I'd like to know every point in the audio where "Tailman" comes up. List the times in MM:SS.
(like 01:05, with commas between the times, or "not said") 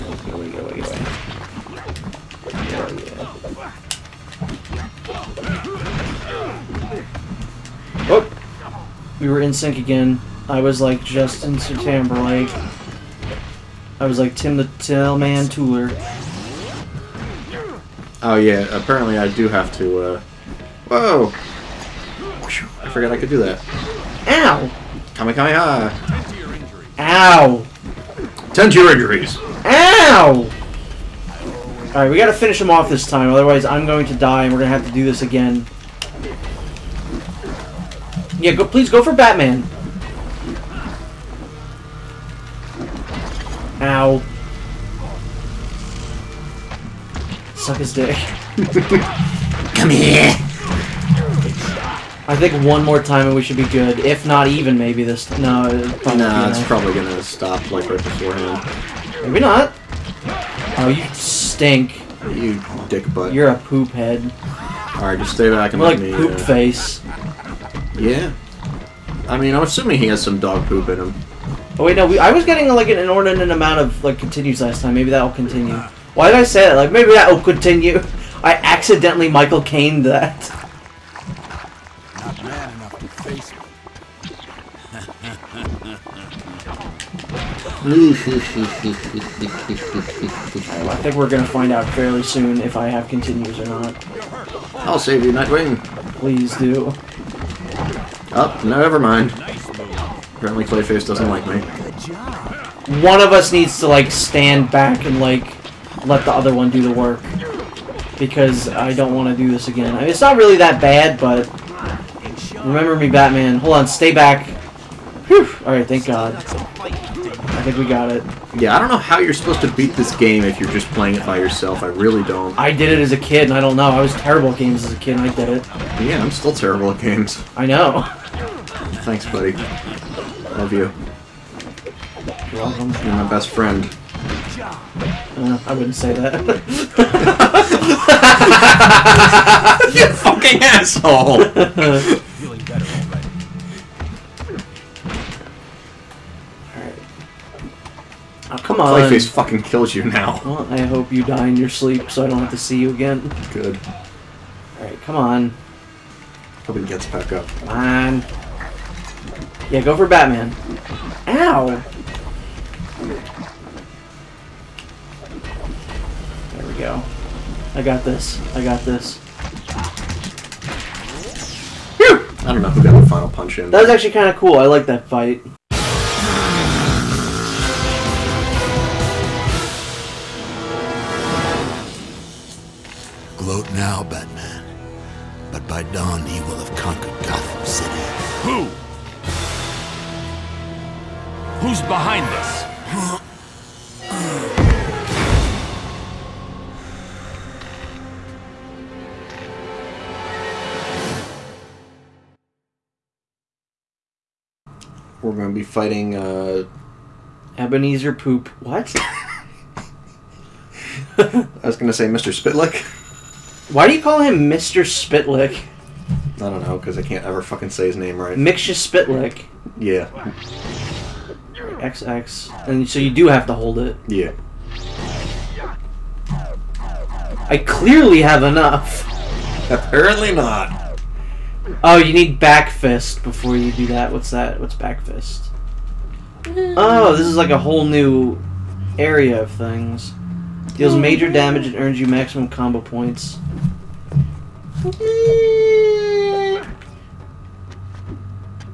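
00:14.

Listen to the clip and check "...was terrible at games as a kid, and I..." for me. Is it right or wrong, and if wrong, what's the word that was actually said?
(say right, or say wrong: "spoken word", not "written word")
right.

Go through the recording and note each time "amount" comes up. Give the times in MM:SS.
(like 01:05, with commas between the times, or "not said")
01:13.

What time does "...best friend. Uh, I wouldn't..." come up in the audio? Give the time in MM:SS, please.
02:13.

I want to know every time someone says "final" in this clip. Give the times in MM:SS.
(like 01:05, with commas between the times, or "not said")
02:53.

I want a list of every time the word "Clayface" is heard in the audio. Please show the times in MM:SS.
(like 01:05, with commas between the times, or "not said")
01:40, 02:28.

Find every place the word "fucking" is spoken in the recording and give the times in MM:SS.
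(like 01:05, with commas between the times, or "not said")
02:20, 02:29, 03:37.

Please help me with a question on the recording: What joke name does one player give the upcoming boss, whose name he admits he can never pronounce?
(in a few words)
Ebenezer Poop.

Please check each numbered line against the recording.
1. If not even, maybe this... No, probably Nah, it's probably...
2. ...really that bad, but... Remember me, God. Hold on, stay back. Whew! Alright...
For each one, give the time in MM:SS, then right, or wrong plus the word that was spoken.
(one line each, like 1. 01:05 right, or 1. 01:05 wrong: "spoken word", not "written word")
1. 00:53 right
2. 01:50 wrong: "Batman", not "God".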